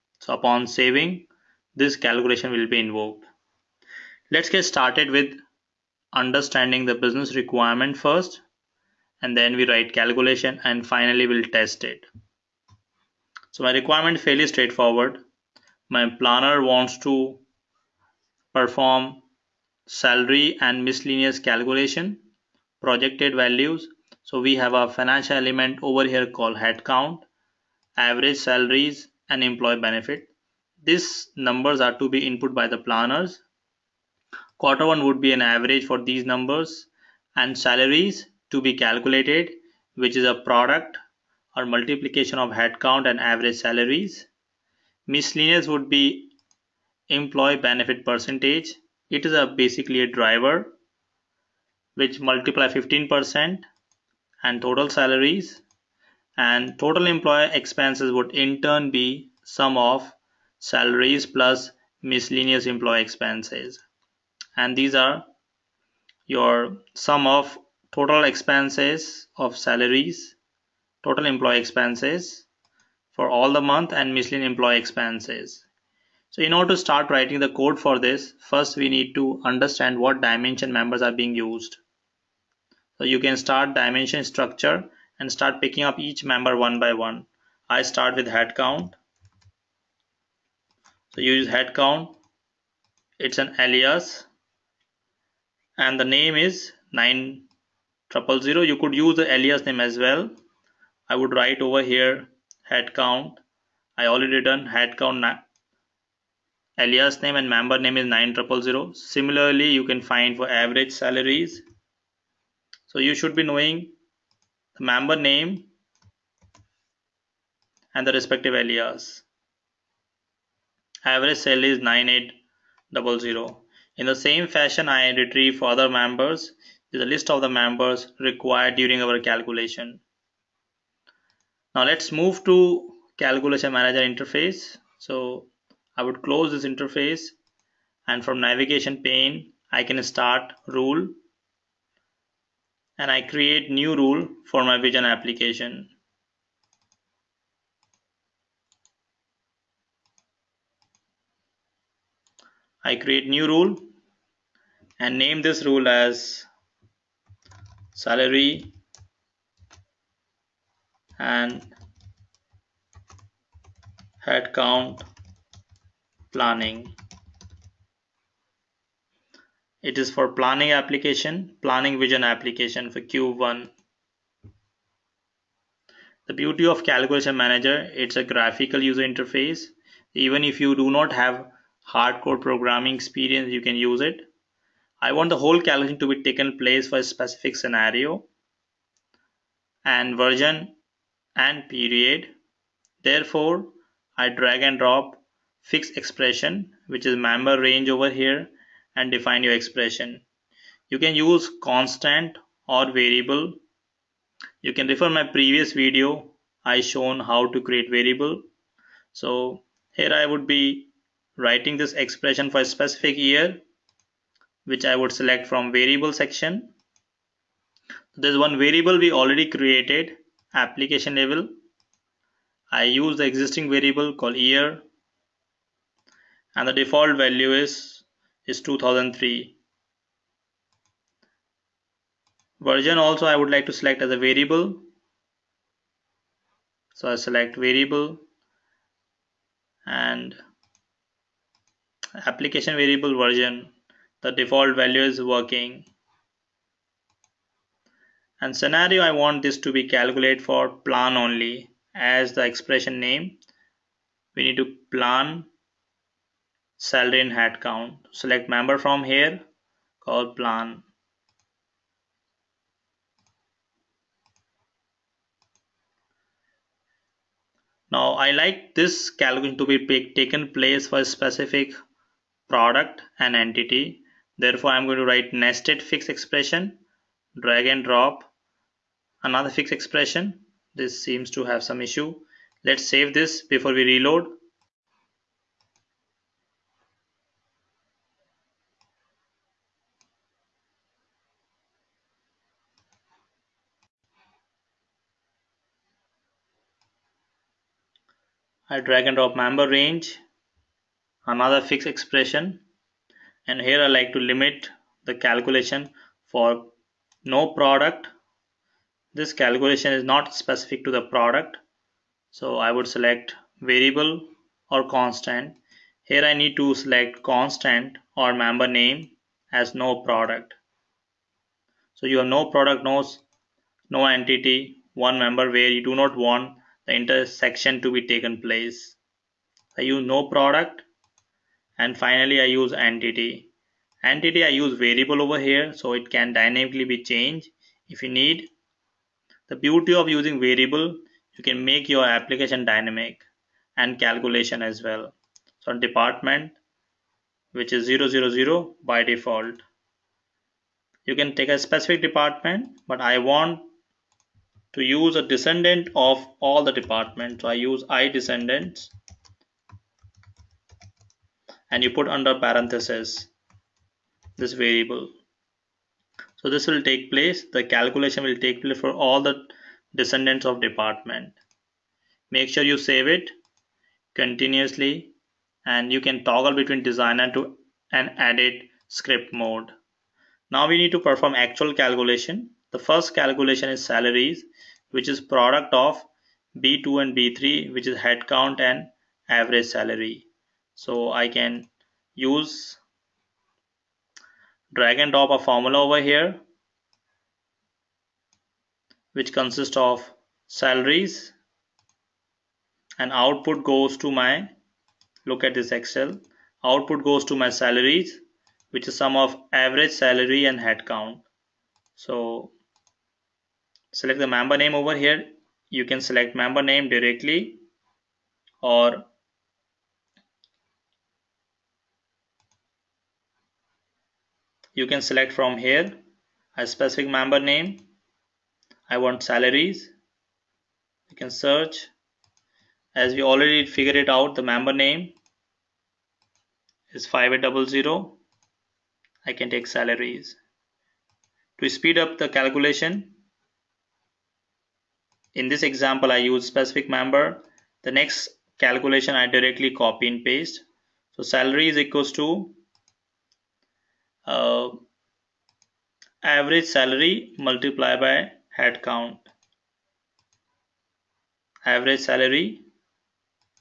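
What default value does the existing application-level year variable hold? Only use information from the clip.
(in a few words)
2003.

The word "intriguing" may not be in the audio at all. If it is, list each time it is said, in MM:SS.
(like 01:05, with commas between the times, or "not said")
not said.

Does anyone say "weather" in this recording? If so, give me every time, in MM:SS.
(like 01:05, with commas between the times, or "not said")
not said.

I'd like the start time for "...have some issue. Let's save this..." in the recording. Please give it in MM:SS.
04:41.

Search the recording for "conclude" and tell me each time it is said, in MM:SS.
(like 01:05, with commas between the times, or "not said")
not said.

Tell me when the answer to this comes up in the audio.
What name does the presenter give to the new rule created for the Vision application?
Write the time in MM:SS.
02:37.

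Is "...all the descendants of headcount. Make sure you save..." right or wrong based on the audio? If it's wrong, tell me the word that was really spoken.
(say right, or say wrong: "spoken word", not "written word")
wrong: "department", not "headcount".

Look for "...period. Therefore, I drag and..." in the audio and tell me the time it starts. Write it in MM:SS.
03:11.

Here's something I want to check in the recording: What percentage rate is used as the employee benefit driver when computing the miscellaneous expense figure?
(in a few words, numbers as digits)
15%.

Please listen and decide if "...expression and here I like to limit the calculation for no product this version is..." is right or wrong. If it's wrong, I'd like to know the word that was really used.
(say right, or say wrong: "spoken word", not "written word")
wrong: "calculation", not "version".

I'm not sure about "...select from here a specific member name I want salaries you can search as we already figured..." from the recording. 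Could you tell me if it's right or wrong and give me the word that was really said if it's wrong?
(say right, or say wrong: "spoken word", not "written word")
right.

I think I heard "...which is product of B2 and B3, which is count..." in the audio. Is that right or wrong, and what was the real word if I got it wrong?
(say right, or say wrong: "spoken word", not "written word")
wrong: "headcount", not "count".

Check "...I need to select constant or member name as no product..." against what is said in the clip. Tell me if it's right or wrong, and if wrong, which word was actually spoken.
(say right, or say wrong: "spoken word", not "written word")
right.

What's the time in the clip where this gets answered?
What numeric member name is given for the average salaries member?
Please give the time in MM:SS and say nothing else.
02:01.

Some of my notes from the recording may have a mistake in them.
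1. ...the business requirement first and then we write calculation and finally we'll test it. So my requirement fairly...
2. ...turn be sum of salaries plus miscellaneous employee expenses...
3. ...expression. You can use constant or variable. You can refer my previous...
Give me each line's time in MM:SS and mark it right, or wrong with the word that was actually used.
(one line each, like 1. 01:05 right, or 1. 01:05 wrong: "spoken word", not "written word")
1. 00:06 right
2. 00:58 right
3. 03:19 right.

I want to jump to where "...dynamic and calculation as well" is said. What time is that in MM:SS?
05:42.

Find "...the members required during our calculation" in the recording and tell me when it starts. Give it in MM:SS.
02:07.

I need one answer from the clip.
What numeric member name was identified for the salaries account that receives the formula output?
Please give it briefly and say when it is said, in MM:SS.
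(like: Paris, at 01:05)
5800, at 07:17.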